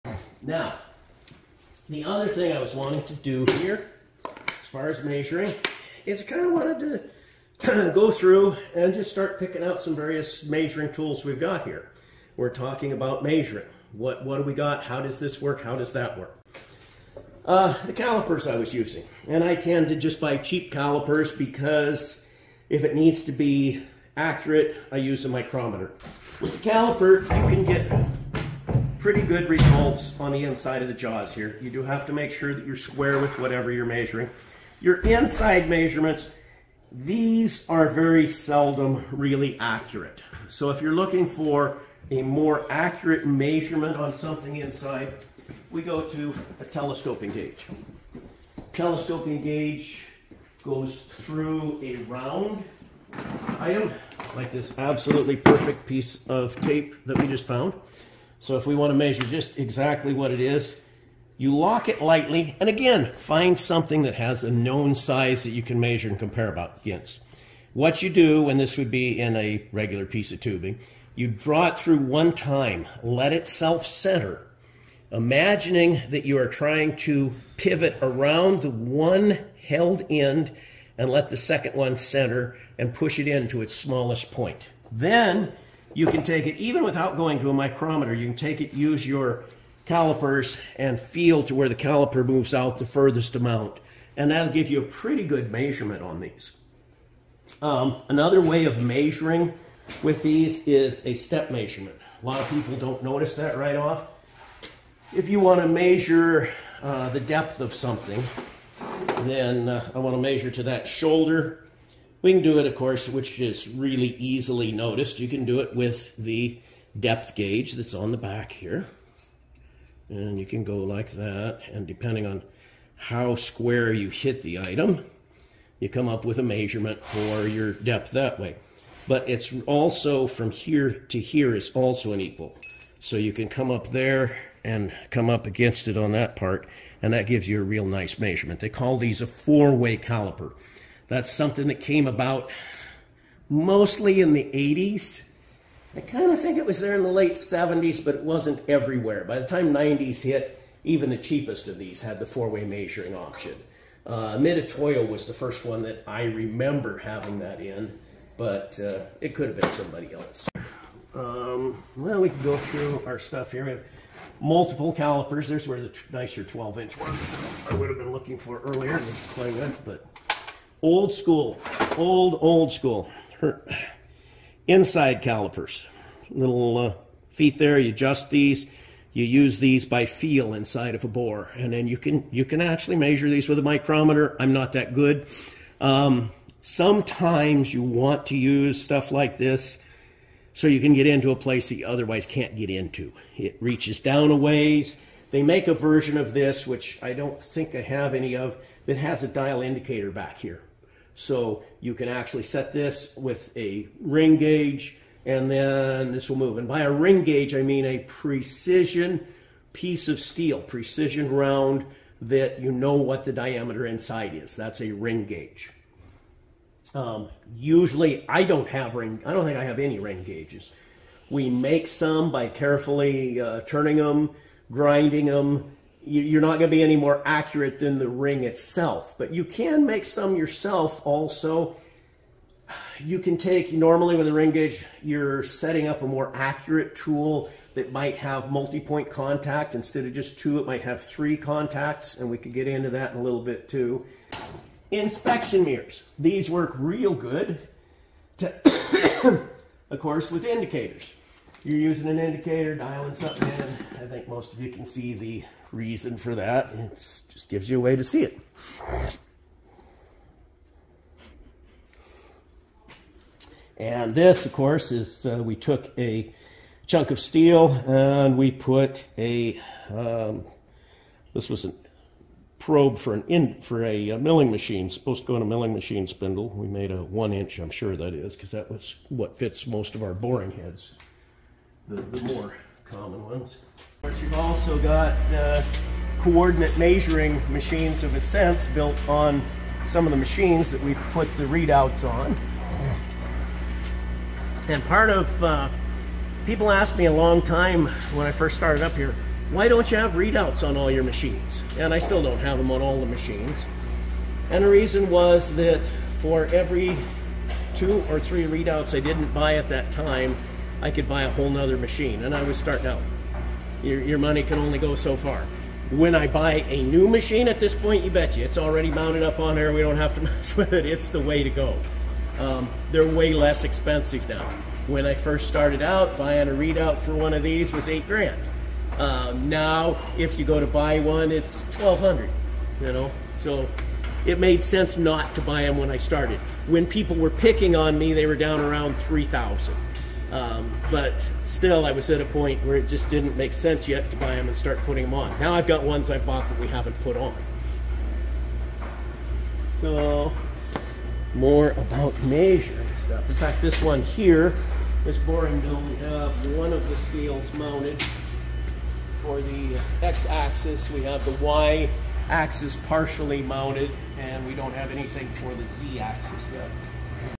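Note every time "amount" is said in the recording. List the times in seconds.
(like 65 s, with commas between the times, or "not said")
93 s.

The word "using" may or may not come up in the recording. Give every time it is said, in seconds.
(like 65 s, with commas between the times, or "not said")
18 s, 251 s.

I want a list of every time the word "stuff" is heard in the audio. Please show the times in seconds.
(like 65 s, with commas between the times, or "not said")
163 s, 188 s, 352 s.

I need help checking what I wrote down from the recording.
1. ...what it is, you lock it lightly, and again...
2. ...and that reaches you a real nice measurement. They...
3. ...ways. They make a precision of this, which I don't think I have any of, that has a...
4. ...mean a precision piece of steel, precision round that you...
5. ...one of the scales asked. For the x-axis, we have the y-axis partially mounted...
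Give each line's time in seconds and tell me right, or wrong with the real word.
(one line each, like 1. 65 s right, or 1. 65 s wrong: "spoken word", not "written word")
1. 60 s right
2. 137 s wrong: "gives", not "reaches"
3. 194 s wrong: "version", not "precision"
4. 207 s right
5. 356 s wrong: "mounted", not "asked".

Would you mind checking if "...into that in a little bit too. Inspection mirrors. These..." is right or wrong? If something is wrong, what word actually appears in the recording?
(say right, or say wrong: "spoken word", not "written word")
right.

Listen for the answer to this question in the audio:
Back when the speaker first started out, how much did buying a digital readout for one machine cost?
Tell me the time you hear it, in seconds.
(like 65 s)
327 s.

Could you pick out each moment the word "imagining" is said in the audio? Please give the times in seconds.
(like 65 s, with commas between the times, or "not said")
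75 s.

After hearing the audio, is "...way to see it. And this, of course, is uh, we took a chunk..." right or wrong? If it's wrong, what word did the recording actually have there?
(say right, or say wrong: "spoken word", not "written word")
right.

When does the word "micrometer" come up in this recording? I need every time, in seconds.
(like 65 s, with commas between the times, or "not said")
25 s, 87 s, 183 s.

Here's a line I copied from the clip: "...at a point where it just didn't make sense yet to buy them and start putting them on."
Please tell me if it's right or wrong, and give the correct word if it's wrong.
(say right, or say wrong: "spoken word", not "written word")
right.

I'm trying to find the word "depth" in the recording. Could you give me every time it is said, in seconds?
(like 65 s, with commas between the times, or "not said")
107 s, 116 s, 127 s.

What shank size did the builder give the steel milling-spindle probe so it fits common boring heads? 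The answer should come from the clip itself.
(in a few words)
1 inch.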